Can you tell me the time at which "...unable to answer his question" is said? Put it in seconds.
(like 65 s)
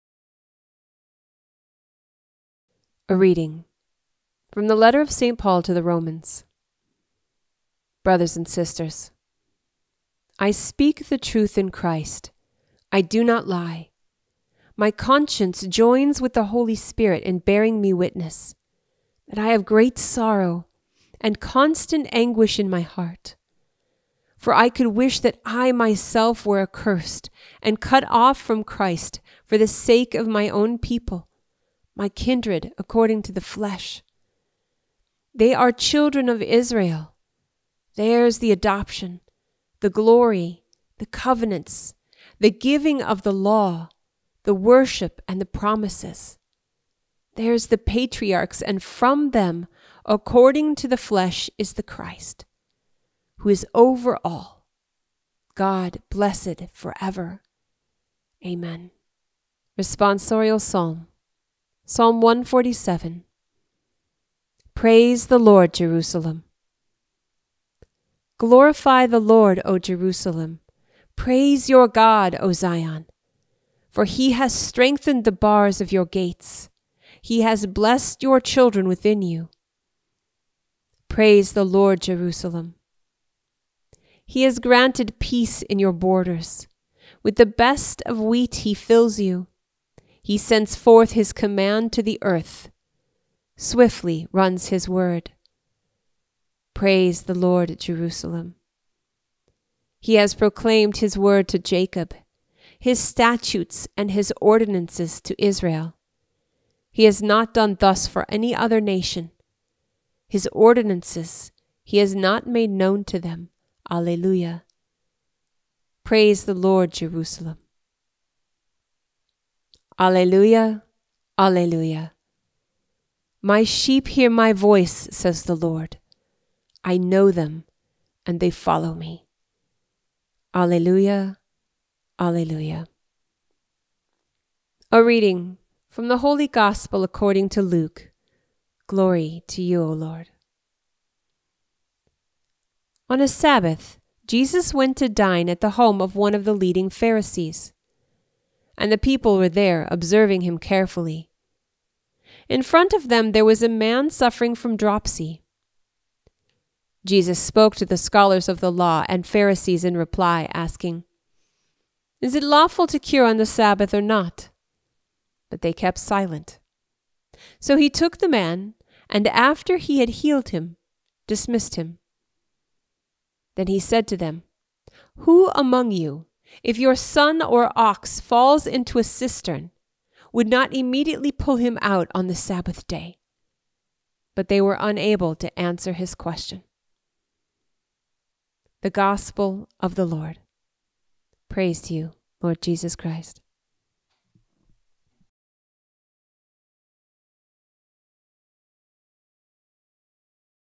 184 s.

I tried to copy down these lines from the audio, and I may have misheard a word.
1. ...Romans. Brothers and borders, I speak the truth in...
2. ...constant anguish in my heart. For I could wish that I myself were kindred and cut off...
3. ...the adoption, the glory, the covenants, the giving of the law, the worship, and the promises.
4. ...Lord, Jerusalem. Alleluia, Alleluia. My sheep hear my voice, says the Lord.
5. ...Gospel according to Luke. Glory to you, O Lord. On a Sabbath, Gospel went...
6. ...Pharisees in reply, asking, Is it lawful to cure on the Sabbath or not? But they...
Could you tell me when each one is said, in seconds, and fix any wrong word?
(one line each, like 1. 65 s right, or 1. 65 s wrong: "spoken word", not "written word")
1. 5 s wrong: "sisters", not "borders"
2. 21 s wrong: "accursed", not "kindred"
3. 38 s right
4. 116 s right
5. 136 s wrong: "Jesus", not "Gospel"
6. 159 s right.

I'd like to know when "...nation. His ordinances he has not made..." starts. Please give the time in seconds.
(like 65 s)
108 s.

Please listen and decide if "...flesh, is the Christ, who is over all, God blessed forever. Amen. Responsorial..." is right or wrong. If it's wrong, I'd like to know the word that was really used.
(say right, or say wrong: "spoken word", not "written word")
right.